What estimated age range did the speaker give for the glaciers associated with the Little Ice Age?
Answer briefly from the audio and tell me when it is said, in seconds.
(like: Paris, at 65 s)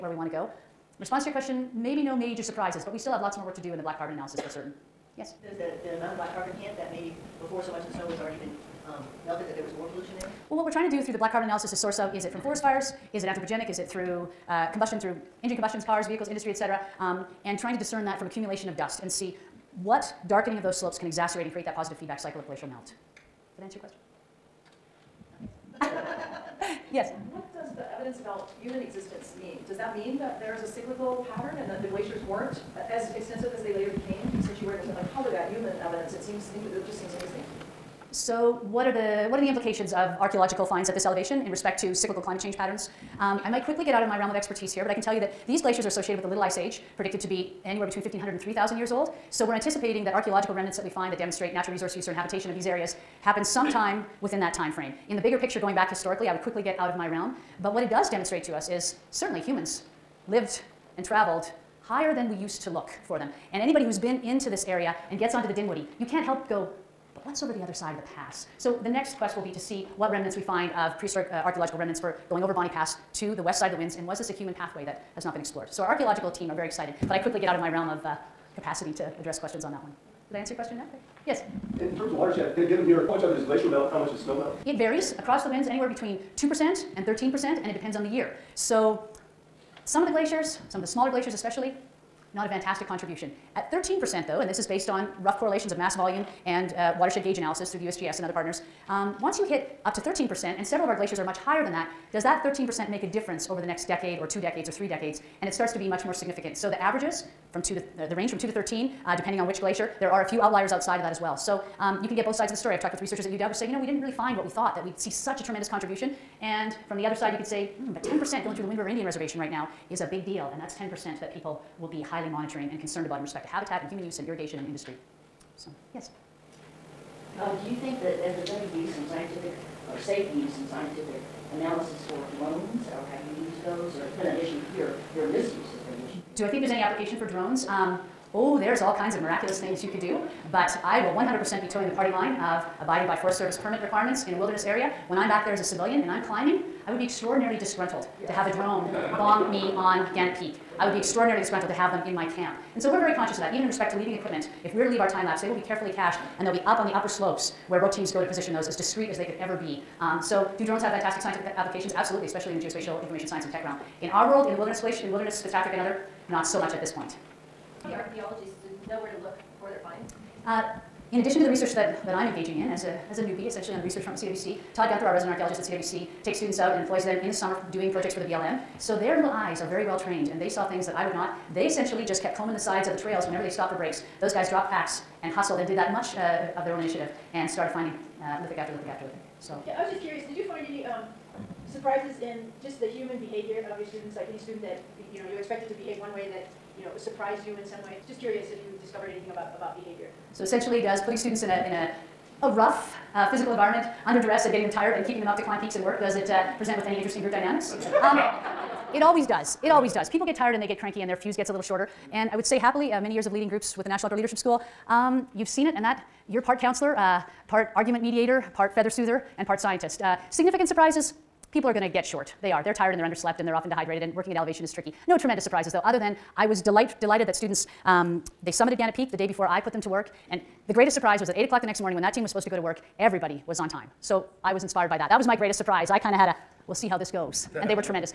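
1,500 to 3,000 years, at 48 s.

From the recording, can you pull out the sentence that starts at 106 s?
So the averages from two to the, the range from 2 to 13, uh, depending on which glacier.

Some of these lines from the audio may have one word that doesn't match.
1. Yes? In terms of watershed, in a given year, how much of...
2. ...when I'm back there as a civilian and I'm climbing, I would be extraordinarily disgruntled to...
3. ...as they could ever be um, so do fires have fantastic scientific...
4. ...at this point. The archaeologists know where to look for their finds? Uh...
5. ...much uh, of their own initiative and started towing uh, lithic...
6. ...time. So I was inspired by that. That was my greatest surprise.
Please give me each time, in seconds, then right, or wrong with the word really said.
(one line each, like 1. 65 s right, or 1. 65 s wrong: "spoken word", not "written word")
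1. 81 s right
2. 145 s right
3. 159 s wrong: "drones", not "fires"
4. 166 s right
5. 185 s wrong: "finding", not "towing"
6. 233 s right.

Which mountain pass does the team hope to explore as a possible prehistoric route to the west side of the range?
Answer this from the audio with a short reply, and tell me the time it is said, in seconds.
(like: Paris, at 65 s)
Bonney Pass, at 72 s.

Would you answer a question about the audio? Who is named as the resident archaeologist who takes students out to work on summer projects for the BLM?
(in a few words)
Todd Guenther.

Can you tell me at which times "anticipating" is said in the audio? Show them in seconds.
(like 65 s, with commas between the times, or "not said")
49 s.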